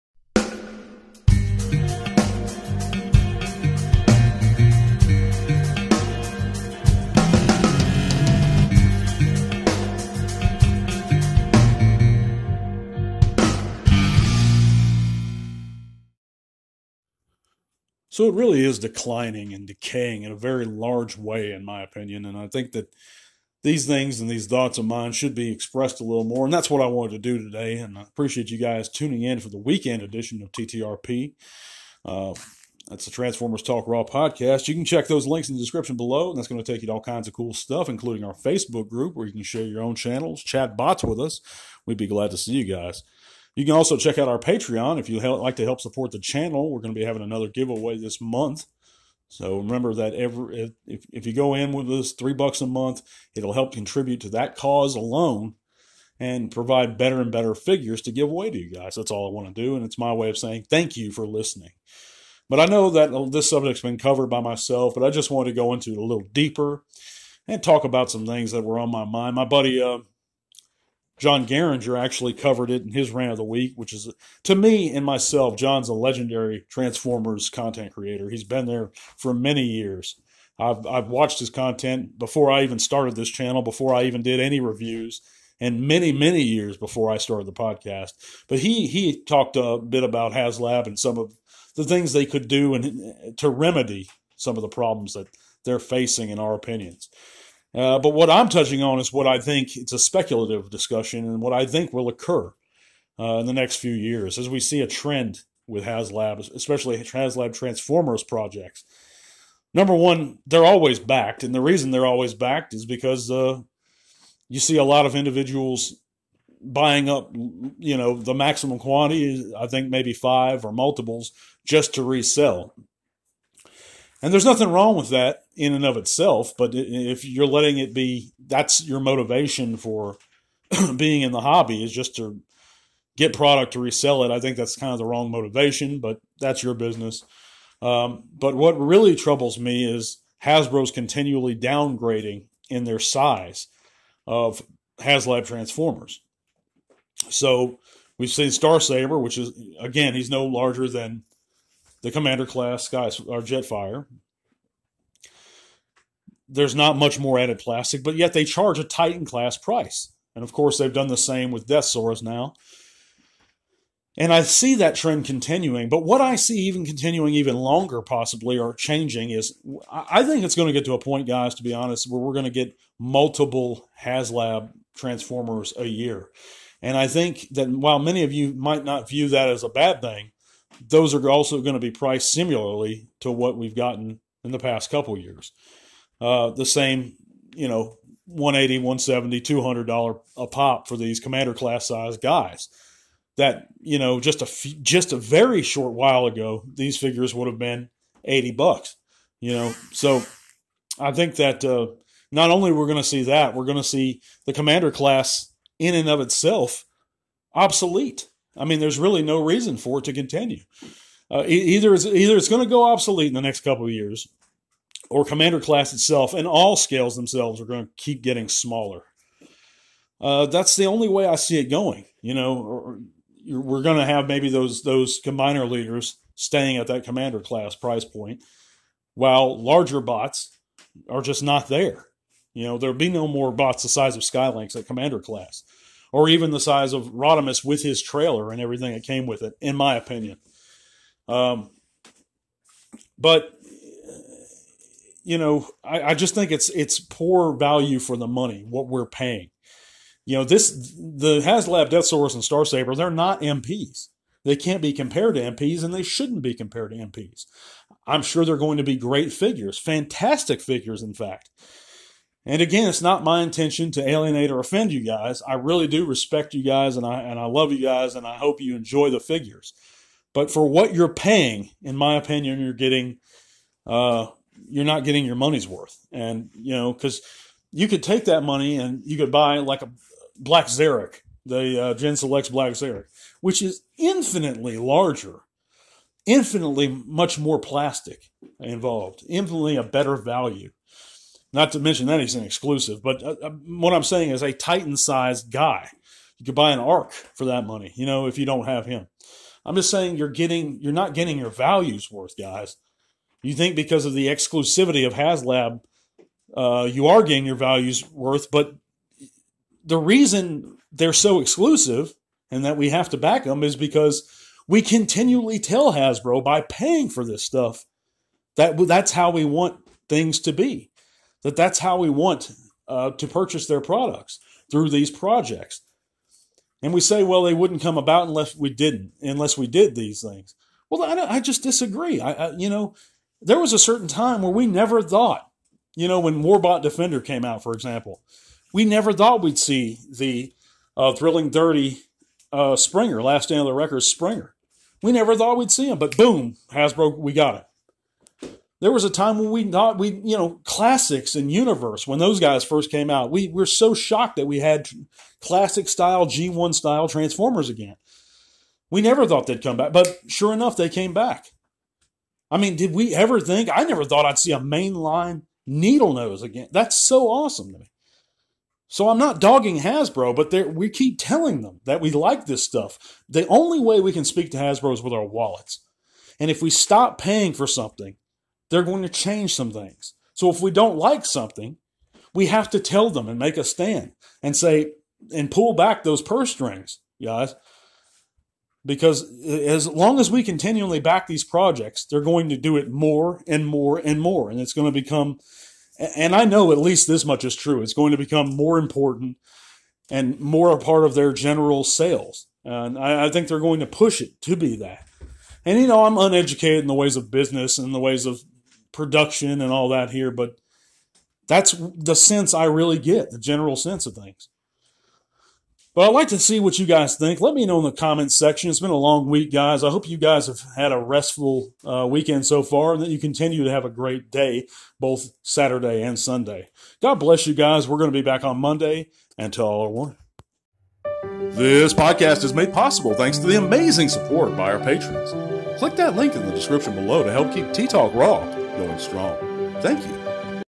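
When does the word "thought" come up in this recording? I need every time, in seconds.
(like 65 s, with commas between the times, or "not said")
24 s, 335 s, 339 s, 345 s, 349 s, 359 s, 364 s.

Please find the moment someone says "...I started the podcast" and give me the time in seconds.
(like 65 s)
87 s.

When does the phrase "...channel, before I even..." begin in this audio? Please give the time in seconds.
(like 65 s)
83 s.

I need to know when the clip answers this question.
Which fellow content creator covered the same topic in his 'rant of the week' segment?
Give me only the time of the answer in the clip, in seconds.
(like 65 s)
71 s.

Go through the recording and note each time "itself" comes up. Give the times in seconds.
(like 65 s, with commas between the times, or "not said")
125 s, 206 s, 215 s.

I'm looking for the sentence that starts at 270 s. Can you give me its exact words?
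But for what you're paying, in my opinion, you're getting uh, you're not getting your money's worth.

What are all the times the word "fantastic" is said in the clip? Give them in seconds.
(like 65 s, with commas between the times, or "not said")
259 s.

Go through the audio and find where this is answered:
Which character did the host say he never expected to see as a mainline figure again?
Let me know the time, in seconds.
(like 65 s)
365 s.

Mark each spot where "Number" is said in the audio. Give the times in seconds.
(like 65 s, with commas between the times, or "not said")
109 s.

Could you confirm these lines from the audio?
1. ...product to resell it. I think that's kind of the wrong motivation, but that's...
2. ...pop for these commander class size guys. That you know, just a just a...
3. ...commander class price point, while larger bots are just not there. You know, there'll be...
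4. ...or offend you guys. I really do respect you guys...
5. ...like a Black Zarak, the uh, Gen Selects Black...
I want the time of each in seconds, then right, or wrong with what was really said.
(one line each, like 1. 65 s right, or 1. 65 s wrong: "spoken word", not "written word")
1. 133 s right
2. 190 s right
3. 227 s right
4. 264 s right
5. 279 s right.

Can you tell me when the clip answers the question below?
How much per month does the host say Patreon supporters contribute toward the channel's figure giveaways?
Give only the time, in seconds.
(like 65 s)
52 s.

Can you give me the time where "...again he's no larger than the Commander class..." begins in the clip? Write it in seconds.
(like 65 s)
149 s.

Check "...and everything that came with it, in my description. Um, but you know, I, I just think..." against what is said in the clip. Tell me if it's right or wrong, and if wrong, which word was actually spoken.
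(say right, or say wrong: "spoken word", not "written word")
wrong: "opinion", not "description".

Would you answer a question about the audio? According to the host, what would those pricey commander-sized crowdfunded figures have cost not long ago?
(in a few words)
$80.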